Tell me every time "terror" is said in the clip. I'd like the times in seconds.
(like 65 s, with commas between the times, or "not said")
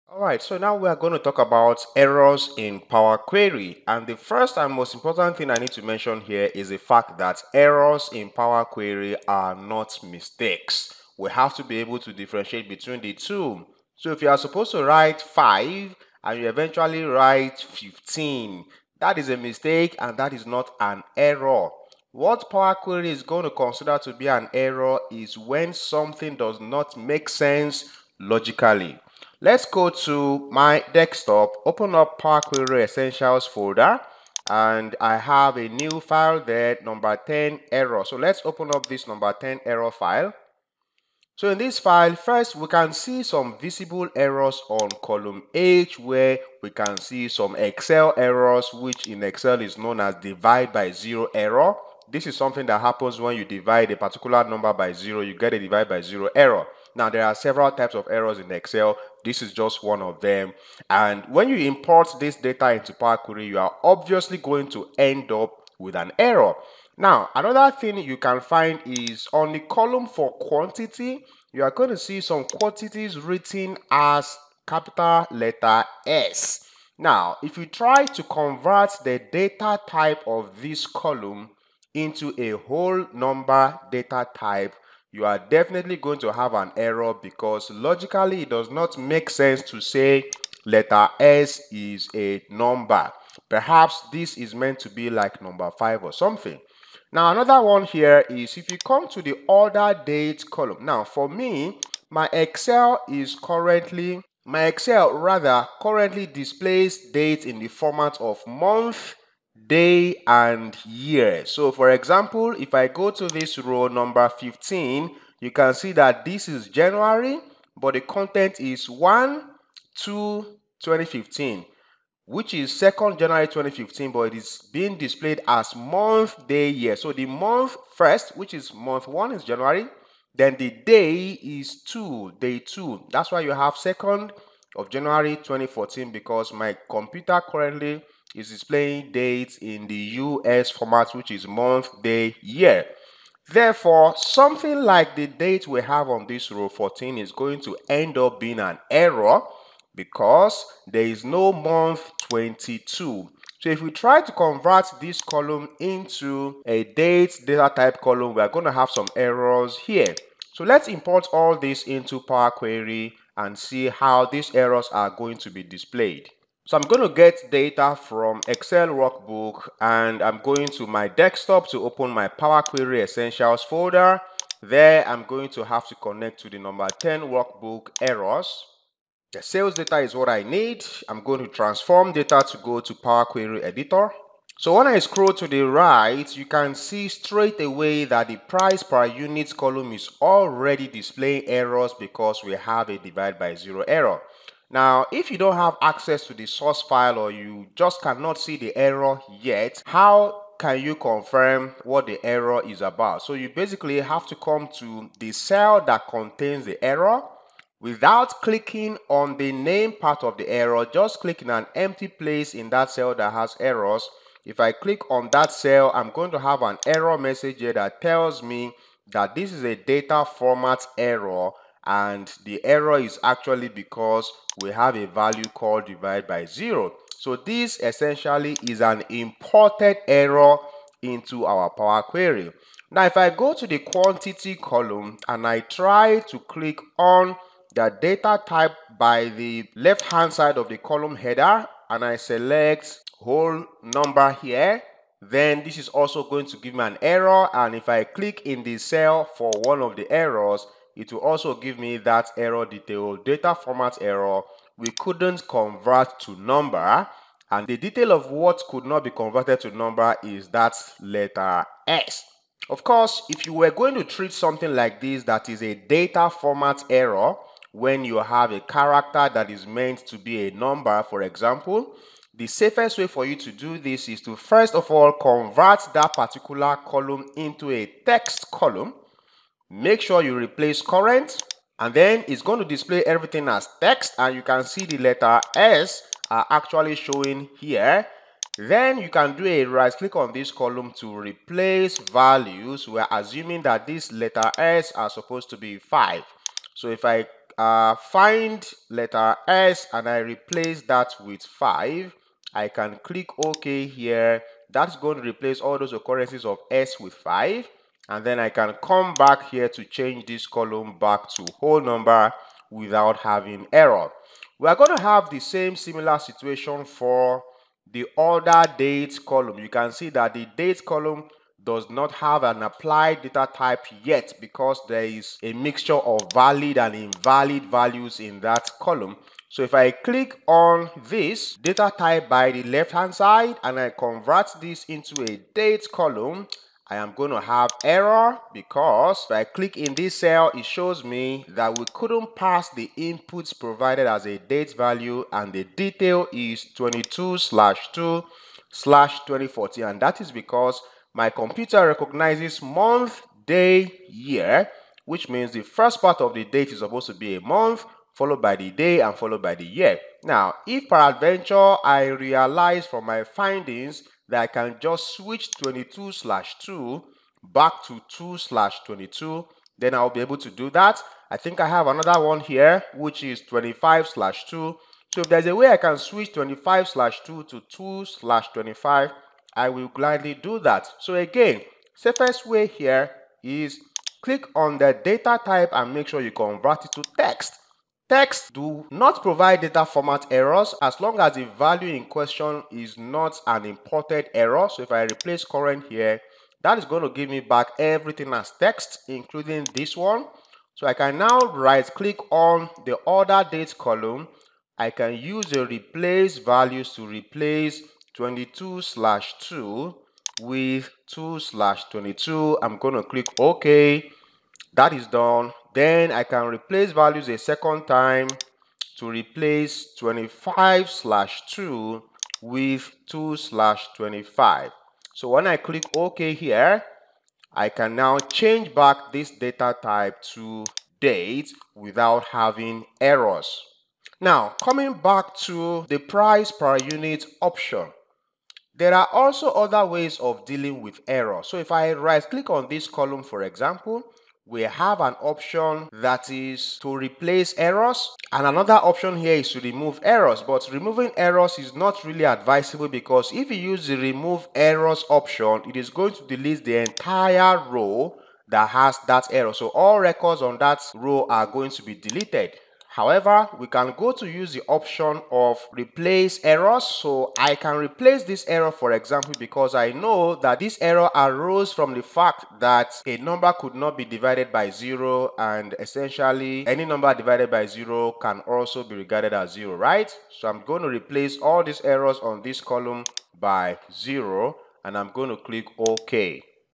not said.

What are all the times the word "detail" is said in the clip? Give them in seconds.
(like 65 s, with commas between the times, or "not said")
252 s, 257 s, 345 s.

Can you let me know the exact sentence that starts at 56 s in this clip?
Now, there are several types of errors in Excel.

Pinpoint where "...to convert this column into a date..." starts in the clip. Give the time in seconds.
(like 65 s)
154 s.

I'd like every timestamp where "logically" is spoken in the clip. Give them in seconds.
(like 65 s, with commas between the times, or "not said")
28 s, 87 s.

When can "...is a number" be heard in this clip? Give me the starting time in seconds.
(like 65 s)
91 s.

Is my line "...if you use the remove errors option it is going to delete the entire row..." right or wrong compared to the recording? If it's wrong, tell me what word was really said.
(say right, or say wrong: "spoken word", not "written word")
right.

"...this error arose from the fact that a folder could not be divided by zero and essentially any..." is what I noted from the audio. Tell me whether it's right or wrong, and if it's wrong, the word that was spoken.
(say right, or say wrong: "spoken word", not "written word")
wrong: "number", not "folder".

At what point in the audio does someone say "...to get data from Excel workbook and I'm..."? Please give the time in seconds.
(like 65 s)
167 s.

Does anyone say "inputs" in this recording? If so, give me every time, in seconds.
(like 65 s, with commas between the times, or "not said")
342 s.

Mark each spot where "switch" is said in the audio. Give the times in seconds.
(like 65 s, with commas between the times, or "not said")
365 s, 375 s.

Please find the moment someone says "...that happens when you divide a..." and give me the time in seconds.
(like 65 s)
52 s.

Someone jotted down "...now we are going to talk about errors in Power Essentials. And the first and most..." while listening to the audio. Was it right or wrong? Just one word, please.
wrong.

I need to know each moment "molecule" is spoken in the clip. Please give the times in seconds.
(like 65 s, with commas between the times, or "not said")
not said.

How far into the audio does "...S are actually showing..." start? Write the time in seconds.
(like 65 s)
285 s.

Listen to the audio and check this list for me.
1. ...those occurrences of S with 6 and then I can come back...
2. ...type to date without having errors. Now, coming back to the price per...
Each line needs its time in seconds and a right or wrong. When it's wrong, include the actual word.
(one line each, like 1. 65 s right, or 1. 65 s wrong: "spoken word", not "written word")
1. 305 s wrong: "5", not "6"
2. 429 s right.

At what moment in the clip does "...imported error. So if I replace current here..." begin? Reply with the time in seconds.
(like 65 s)
393 s.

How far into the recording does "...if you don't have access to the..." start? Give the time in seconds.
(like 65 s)
195 s.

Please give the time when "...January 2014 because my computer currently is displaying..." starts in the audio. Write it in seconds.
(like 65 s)
134 s.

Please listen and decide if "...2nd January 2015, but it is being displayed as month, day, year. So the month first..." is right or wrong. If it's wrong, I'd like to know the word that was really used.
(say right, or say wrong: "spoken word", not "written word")
right.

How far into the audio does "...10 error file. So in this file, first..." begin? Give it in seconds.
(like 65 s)
39 s.